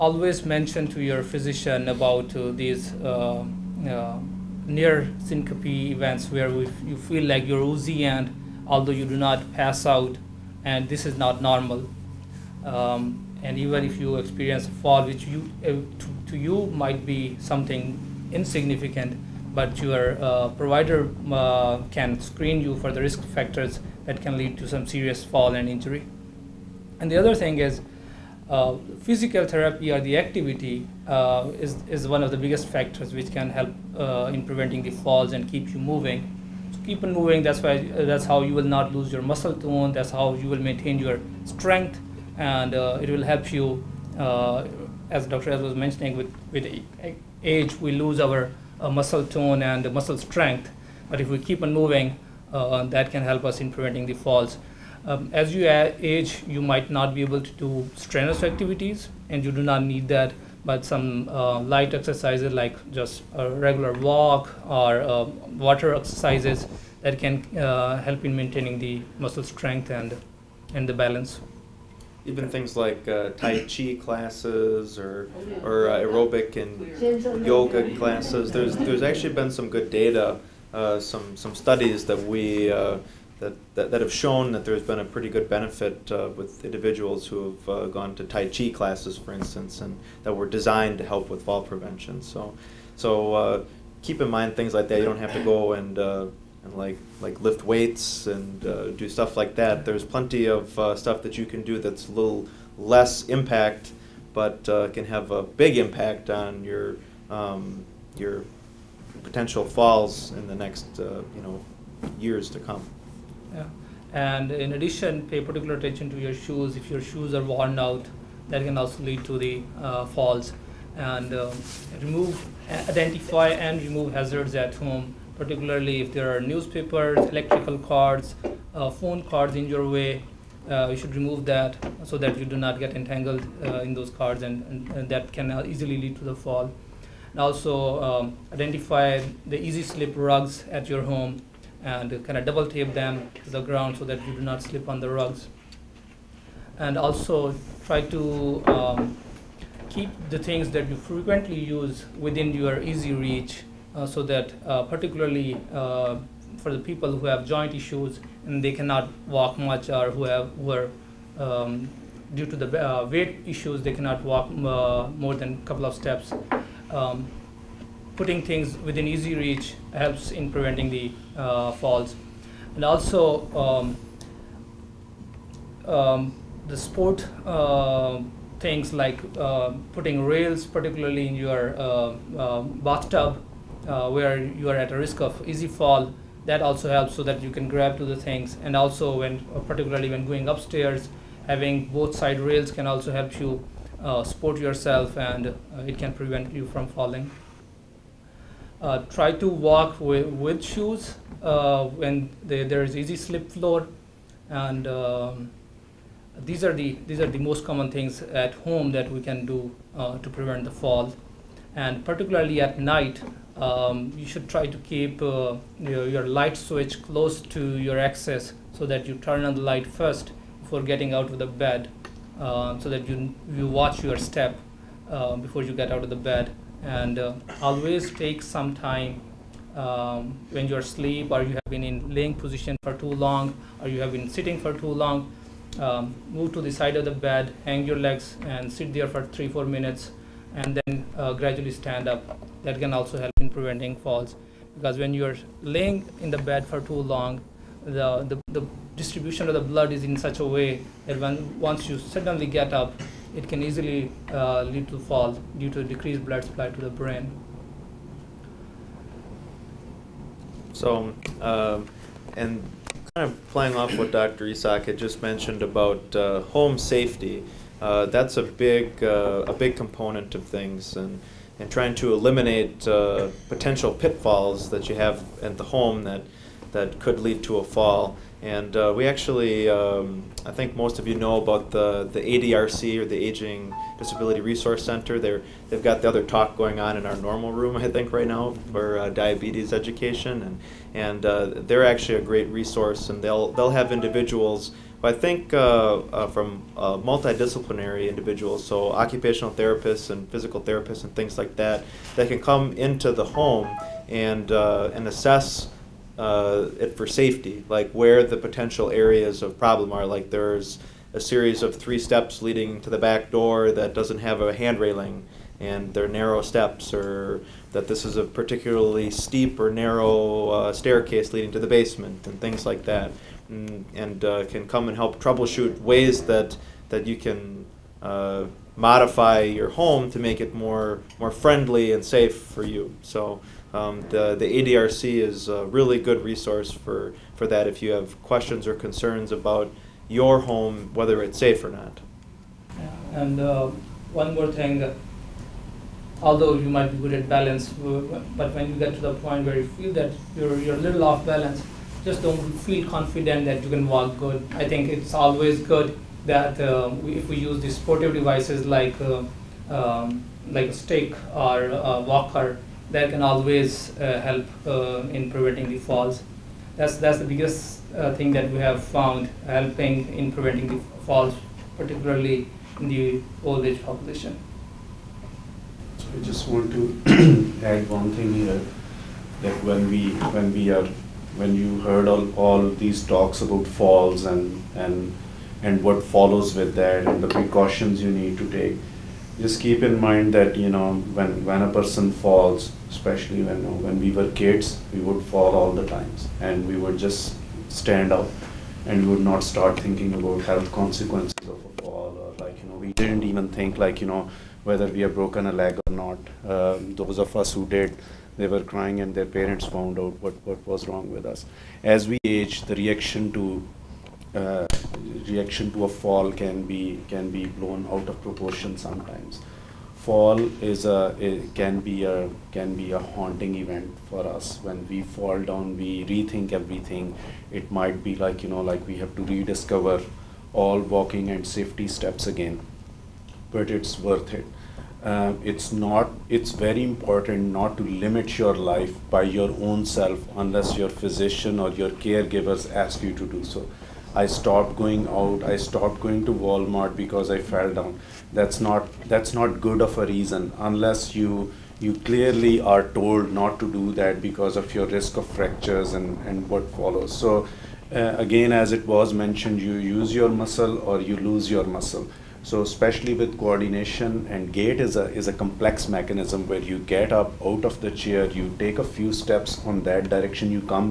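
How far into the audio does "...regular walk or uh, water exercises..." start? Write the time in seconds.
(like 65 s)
63 s.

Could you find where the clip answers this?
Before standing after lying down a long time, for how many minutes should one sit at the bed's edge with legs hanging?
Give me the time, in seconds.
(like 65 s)
239 s.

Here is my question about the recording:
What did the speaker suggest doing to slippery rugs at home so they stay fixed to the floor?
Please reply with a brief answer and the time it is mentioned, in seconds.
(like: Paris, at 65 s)
double tape them, at 142 s.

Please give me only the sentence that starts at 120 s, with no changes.
And um, remove, identify and remove hazards at home, particularly if there are newspapers, electrical cords, uh, phone cords in your way.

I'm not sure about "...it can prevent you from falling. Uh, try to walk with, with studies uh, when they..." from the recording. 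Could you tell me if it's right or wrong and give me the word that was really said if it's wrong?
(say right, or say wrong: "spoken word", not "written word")
wrong: "shoes", not "studies".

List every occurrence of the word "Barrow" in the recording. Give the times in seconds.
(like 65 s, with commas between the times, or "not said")
not said.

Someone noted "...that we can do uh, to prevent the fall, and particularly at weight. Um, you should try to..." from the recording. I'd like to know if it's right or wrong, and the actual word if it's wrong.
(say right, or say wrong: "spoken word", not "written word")
wrong: "night", not "weight".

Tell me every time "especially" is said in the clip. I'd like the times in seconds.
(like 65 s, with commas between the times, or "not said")
392 s, 462 s.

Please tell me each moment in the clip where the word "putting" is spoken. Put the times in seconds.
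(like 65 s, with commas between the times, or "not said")
168 s, 179 s.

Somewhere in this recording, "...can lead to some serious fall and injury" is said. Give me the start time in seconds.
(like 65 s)
24 s.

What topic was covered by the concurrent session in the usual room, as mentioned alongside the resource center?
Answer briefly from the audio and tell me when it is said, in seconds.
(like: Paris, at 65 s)
diabetes education, at 289 s.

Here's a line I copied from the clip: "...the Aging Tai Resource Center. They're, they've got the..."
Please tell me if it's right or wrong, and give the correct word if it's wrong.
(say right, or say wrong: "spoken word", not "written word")
wrong: "Disability", not "Tai".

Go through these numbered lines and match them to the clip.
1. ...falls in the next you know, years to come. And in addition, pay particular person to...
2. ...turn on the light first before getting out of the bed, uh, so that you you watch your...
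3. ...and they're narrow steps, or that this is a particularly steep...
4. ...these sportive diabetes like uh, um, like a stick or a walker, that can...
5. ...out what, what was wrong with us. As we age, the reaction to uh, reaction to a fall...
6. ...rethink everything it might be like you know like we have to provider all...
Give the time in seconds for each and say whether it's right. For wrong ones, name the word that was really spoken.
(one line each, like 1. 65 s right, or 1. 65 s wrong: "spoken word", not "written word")
1. 109 s wrong: "attention", not "person"
2. 219 s right
3. 315 s right
4. 357 s wrong: "devices", not "diabetes"
5. 409 s right
6. 426 s wrong: "rediscover", not "provider".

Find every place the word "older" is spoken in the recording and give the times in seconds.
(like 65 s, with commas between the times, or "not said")
not said.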